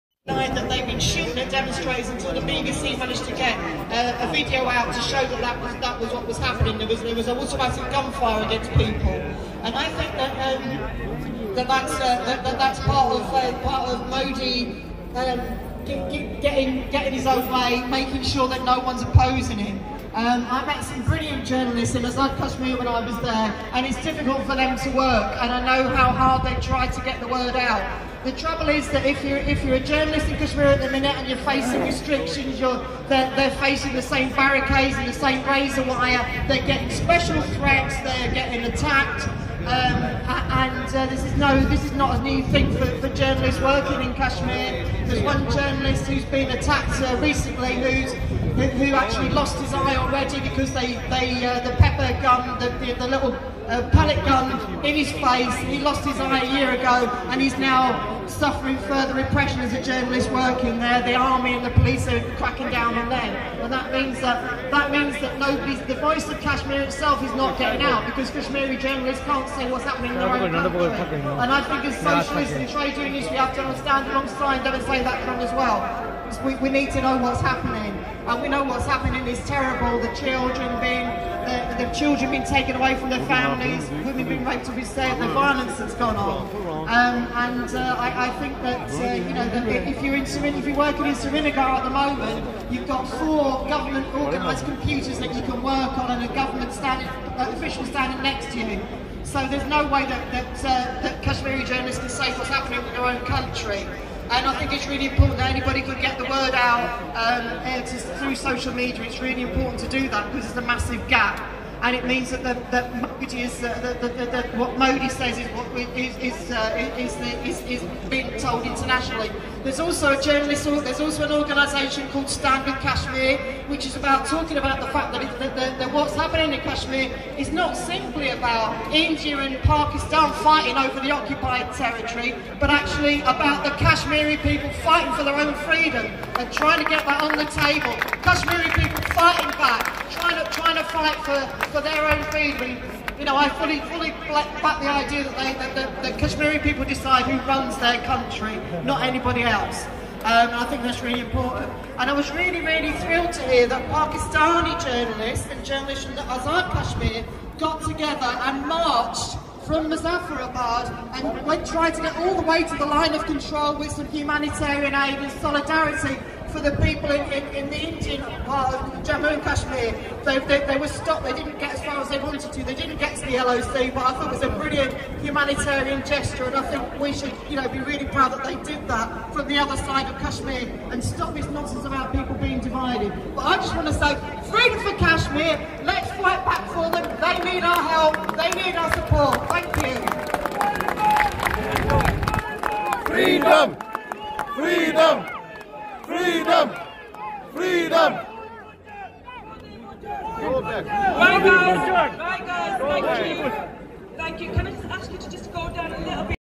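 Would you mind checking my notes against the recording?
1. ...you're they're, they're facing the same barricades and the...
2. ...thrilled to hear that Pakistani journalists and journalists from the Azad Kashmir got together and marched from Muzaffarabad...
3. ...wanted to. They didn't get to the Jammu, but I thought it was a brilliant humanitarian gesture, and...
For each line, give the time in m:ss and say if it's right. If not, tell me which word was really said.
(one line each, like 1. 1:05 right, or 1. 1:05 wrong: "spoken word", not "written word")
1. 0:32 right
2. 2:32 right
3. 2:52 wrong: "LOC", not "Jammu".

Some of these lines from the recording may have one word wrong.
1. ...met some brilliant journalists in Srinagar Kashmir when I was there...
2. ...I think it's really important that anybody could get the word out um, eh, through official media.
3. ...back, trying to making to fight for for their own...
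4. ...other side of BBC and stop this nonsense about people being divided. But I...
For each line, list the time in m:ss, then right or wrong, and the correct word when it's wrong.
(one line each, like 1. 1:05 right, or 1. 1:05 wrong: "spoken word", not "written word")
1. 0:20 wrong: "Azad", not "Srinagar"
2. 1:44 wrong: "social", not "official"
3. 2:19 wrong: "trying", not "making"
4. 2:59 wrong: "Kashmir", not "BBC".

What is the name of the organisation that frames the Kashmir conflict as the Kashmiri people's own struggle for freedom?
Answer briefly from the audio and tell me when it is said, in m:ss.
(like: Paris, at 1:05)
Stand with Kashmir, at 2:02.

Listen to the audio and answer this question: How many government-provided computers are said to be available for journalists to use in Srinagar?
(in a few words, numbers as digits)
4.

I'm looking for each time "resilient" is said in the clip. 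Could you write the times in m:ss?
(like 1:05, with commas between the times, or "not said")
not said.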